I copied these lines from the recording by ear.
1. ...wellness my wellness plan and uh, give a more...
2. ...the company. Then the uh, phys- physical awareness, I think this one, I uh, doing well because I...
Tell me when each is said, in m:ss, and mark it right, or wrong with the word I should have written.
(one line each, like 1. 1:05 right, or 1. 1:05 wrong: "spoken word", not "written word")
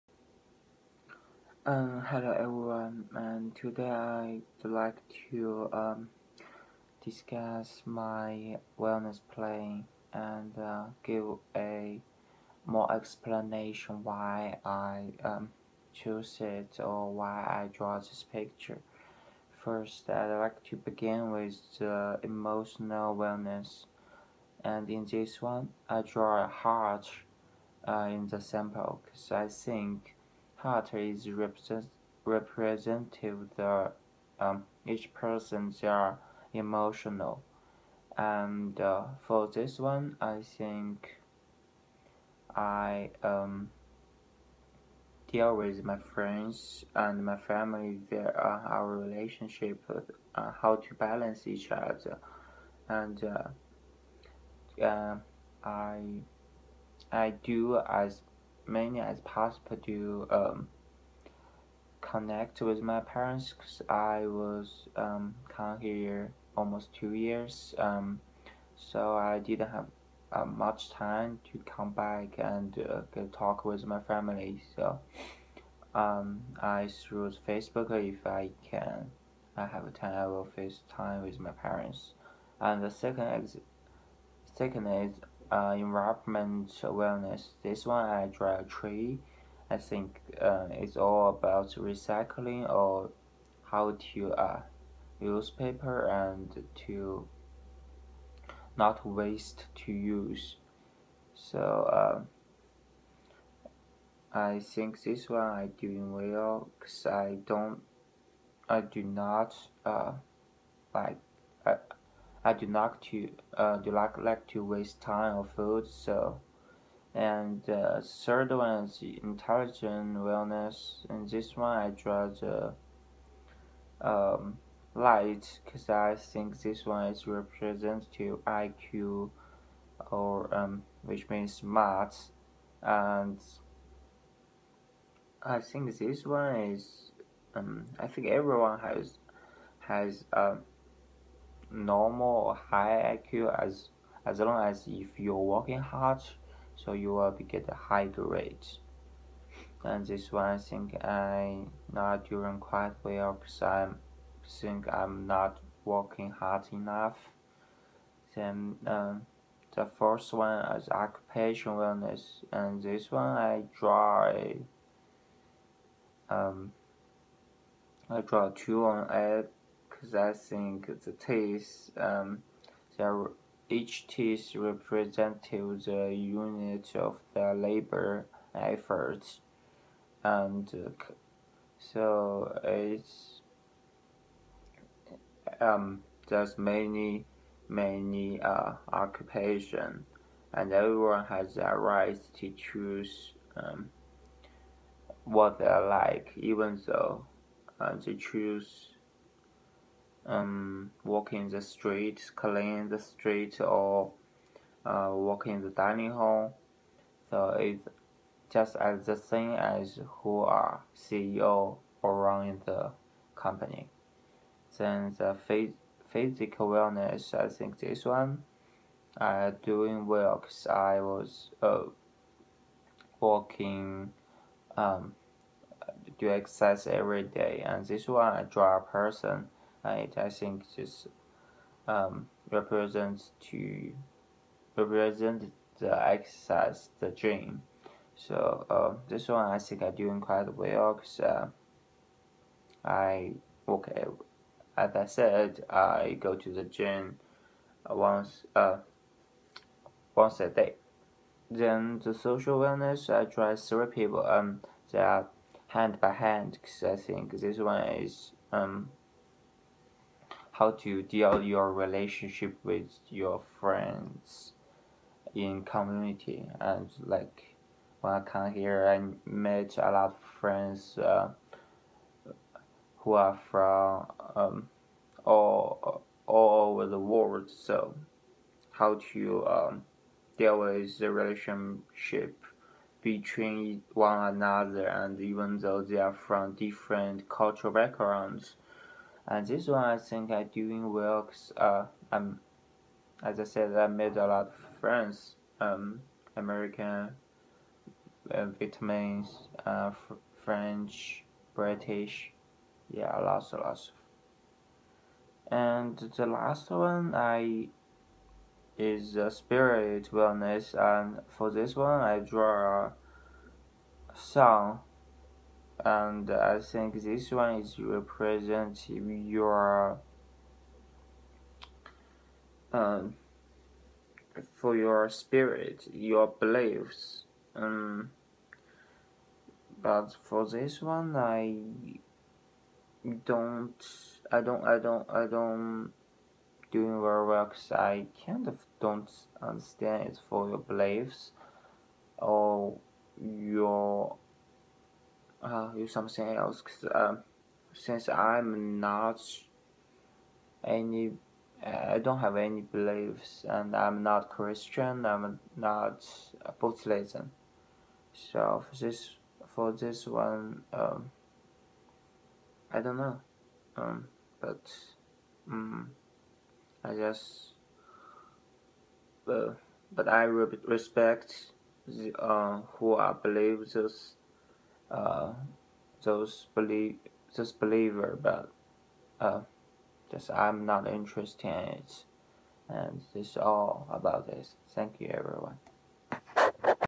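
1. 0:07 wrong: "discuss", not "wellness"
2. 3:32 wrong: "wellness", not "awareness".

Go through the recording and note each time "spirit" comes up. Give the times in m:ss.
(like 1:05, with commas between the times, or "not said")
5:09, 5:25.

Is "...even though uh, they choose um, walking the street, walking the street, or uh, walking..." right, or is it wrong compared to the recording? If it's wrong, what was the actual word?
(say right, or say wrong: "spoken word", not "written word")
wrong: "cleaning", not "walking".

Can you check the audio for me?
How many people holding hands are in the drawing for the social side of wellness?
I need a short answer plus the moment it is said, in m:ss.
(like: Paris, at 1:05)
3, at 4:13.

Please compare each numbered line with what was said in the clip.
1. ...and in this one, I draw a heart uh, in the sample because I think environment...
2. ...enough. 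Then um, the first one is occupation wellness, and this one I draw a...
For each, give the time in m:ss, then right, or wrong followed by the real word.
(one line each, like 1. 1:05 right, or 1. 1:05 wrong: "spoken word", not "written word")
1. 0:24 wrong: "represent", not "environment"
2. 2:36 right.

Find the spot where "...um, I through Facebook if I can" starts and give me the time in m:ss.
1:15.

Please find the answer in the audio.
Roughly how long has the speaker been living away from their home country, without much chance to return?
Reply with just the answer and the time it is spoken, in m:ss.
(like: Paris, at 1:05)
Almost two years, at 1:06.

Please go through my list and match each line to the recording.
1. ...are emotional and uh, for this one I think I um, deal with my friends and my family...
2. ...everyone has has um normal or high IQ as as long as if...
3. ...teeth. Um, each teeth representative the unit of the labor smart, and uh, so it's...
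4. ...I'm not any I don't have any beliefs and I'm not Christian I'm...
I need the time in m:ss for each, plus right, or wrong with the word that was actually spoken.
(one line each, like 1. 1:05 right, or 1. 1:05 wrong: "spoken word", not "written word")
1. 0:35 right
2. 2:18 right
3. 2:51 wrong: "effort", not "smart"
4. 5:48 right.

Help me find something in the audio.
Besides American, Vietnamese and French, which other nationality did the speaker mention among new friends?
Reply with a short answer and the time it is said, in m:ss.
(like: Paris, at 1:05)
British, at 5:01.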